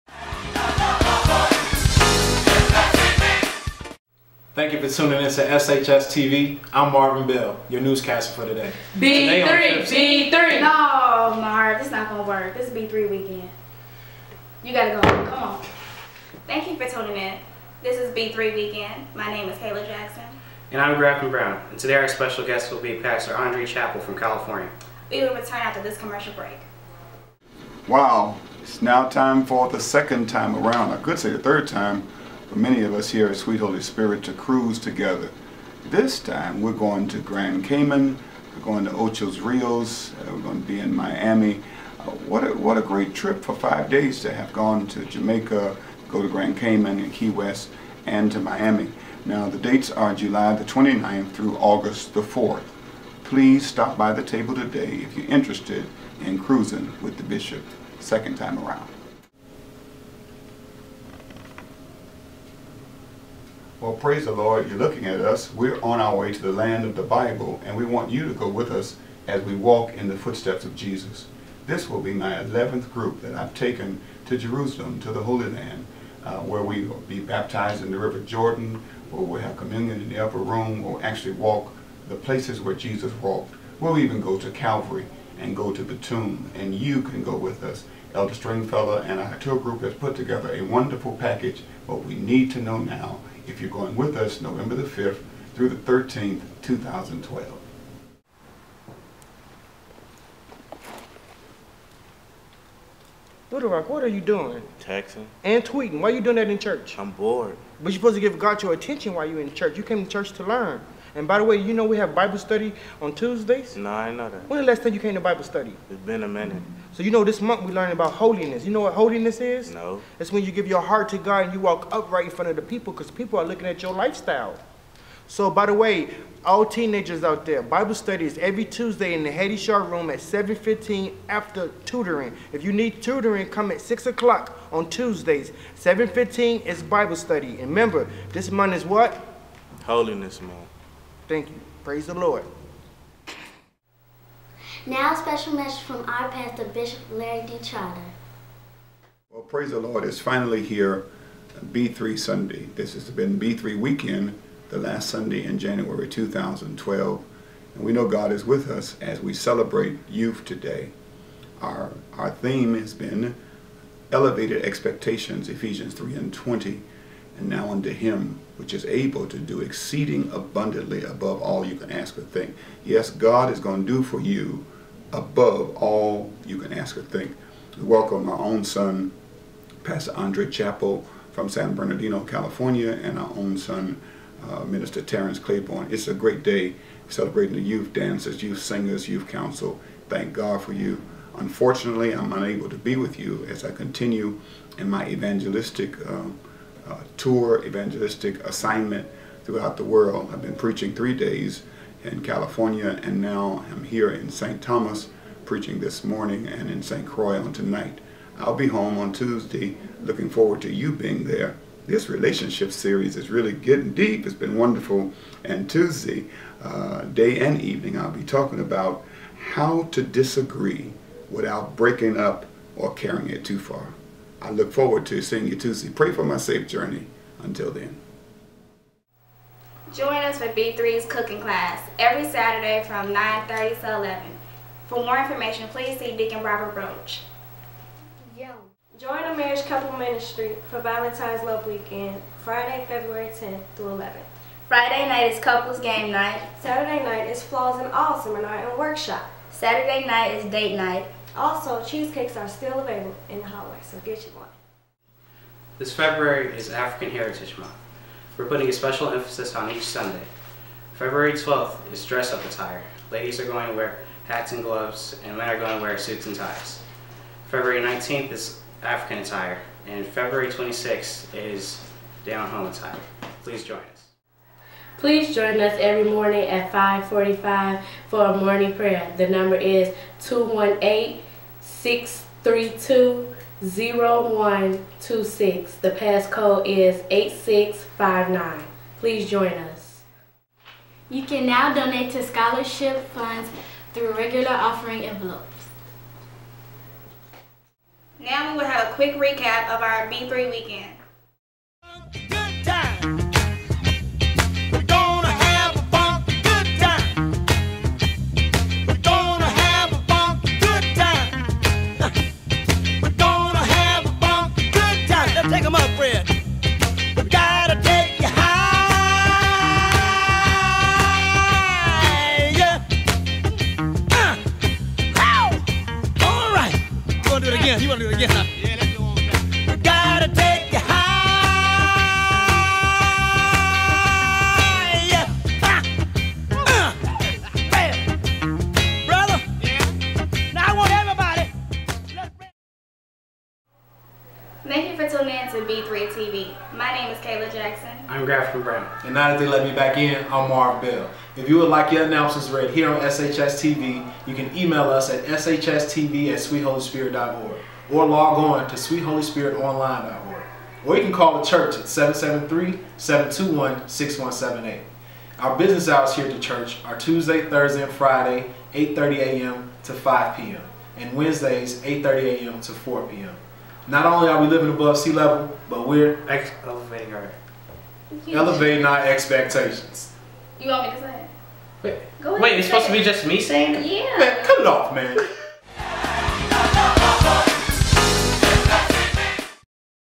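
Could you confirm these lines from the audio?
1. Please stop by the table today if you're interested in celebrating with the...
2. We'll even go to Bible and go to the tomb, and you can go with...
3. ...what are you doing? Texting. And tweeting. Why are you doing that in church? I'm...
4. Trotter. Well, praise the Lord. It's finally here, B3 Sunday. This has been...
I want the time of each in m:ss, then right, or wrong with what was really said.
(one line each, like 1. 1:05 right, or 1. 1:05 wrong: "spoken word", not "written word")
1. 0:53 wrong: "cruising", not "celebrating"
2. 1:23 wrong: "Calvary", not "Bible"
3. 1:43 right
4. 2:27 right.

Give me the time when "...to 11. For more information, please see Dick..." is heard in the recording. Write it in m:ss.
3:53.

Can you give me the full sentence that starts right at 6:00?
Or you can call the church at 773-721-6178.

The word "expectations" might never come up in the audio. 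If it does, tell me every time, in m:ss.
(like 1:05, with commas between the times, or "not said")
2:44, 6:19.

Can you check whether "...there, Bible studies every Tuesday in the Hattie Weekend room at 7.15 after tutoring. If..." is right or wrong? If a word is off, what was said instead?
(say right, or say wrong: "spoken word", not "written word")
wrong: "Shaw", not "Weekend".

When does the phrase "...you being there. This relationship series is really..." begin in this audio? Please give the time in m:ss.
3:30.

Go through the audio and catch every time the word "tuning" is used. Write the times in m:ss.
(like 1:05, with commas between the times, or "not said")
0:04, 0:16, 5:45.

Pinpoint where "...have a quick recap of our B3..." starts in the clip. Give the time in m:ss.
4:58.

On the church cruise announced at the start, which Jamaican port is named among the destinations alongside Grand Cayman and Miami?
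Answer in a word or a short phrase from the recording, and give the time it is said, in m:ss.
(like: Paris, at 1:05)
Ochos Rios, at 0:38.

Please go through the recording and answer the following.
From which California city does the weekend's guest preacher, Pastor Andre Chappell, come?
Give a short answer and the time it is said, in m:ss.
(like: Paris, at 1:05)
San Bernardino, at 3:01.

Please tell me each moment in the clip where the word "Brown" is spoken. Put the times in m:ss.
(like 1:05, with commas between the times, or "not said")
0:21, 5:48.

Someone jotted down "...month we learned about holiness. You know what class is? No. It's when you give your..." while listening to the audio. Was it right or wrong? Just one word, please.
wrong.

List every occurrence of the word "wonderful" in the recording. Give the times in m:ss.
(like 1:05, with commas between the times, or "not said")
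1:30, 3:34.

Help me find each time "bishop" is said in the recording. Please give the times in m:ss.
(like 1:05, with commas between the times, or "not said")
0:57, 2:26.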